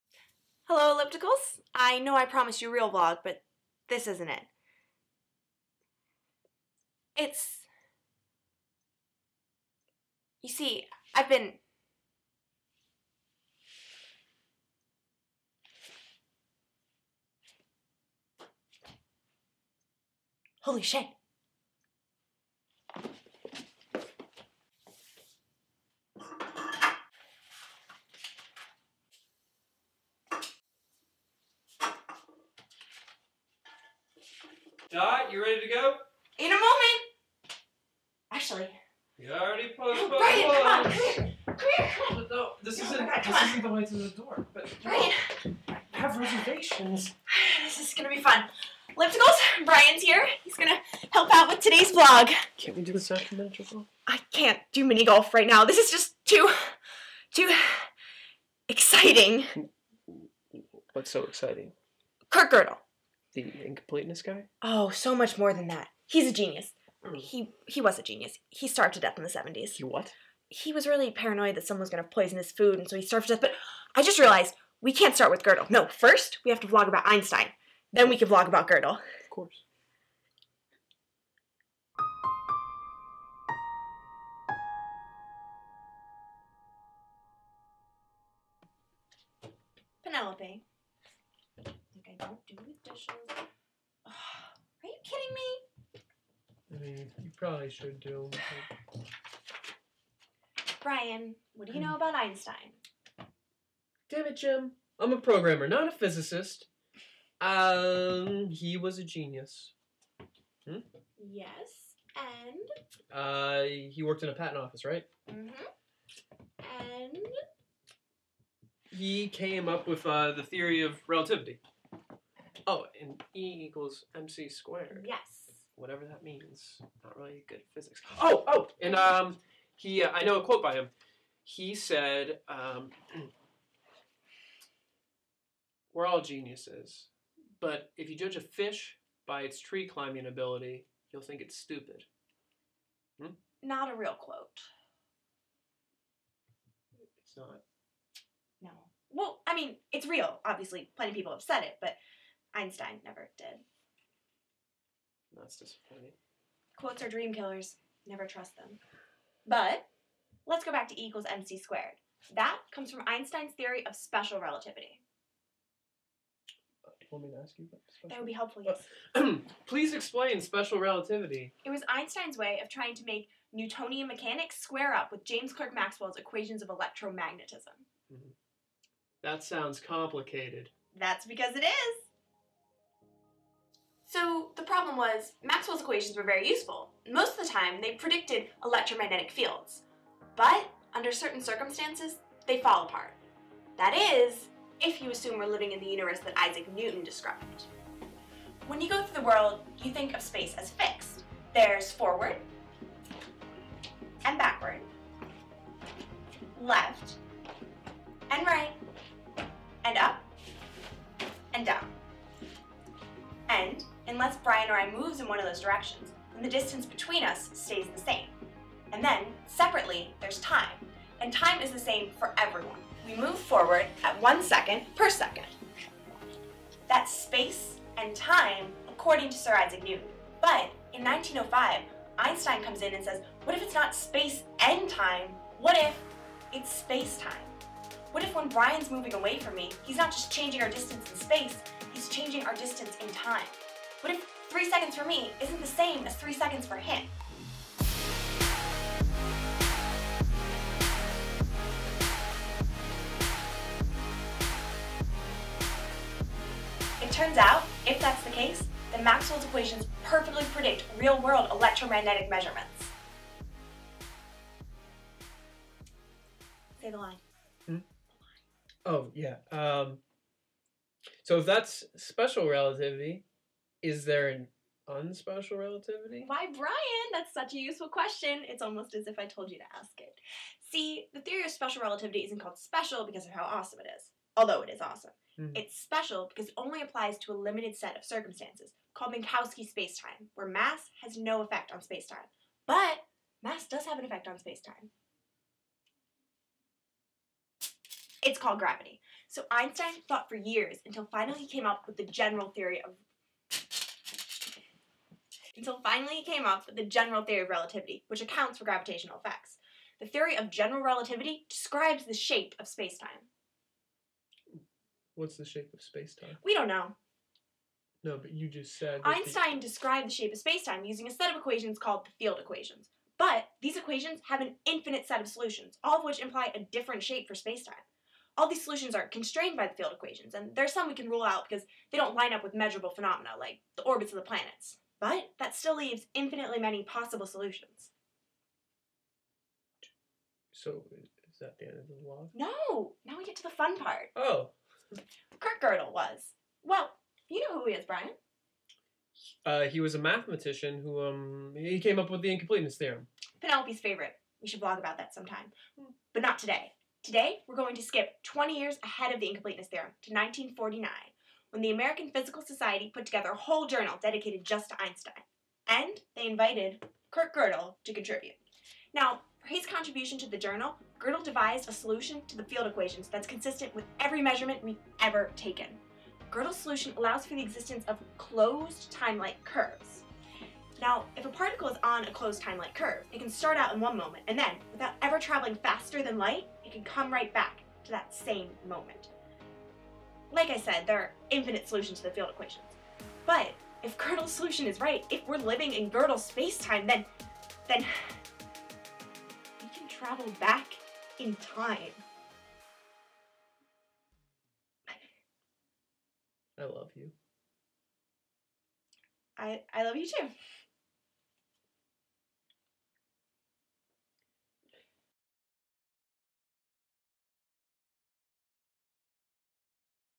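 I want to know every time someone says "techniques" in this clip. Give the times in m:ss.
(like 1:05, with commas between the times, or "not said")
not said.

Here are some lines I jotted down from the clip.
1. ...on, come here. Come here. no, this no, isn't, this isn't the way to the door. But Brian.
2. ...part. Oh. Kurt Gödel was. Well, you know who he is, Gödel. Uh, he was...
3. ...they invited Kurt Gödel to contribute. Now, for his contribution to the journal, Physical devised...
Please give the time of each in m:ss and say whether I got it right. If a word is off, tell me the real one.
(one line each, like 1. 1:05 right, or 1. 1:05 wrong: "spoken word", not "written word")
1. 0:40 right
2. 5:43 wrong: "Brian", not "Gödel"
3. 6:06 wrong: "Gödel", not "Physical".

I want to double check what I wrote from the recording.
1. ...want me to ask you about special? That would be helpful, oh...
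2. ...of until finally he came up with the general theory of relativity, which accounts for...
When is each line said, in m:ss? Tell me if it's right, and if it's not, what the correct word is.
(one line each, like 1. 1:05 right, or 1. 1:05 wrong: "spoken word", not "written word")
1. 2:47 right
2. 5:02 right.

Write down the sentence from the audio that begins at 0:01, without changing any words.
I know I promised you a real vlog, but this isn't it.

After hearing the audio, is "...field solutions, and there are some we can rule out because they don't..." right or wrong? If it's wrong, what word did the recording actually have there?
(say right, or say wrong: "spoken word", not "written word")
wrong: "equations", not "solutions".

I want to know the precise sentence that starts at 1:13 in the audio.
But I just realized we can't start with Gödel.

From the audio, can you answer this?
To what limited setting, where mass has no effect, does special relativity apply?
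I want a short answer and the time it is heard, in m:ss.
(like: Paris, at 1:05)
Minkowski space-time, at 4:49.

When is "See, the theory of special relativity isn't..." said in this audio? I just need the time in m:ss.
4:40.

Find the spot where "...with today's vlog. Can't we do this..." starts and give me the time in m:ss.
0:51.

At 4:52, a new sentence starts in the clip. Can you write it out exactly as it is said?
But mass does have an effect on space-time.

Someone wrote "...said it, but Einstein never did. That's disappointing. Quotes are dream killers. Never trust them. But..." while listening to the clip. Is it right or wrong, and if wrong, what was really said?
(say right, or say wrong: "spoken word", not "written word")
right.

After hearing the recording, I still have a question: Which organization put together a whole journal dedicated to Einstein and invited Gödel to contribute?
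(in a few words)
American Physical Society.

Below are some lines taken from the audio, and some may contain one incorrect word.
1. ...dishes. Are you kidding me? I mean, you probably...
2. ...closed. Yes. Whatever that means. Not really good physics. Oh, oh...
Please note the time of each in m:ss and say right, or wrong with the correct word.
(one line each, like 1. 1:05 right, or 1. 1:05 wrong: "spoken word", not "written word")
1. 1:32 right
2. 2:04 wrong: "squared", not "closed".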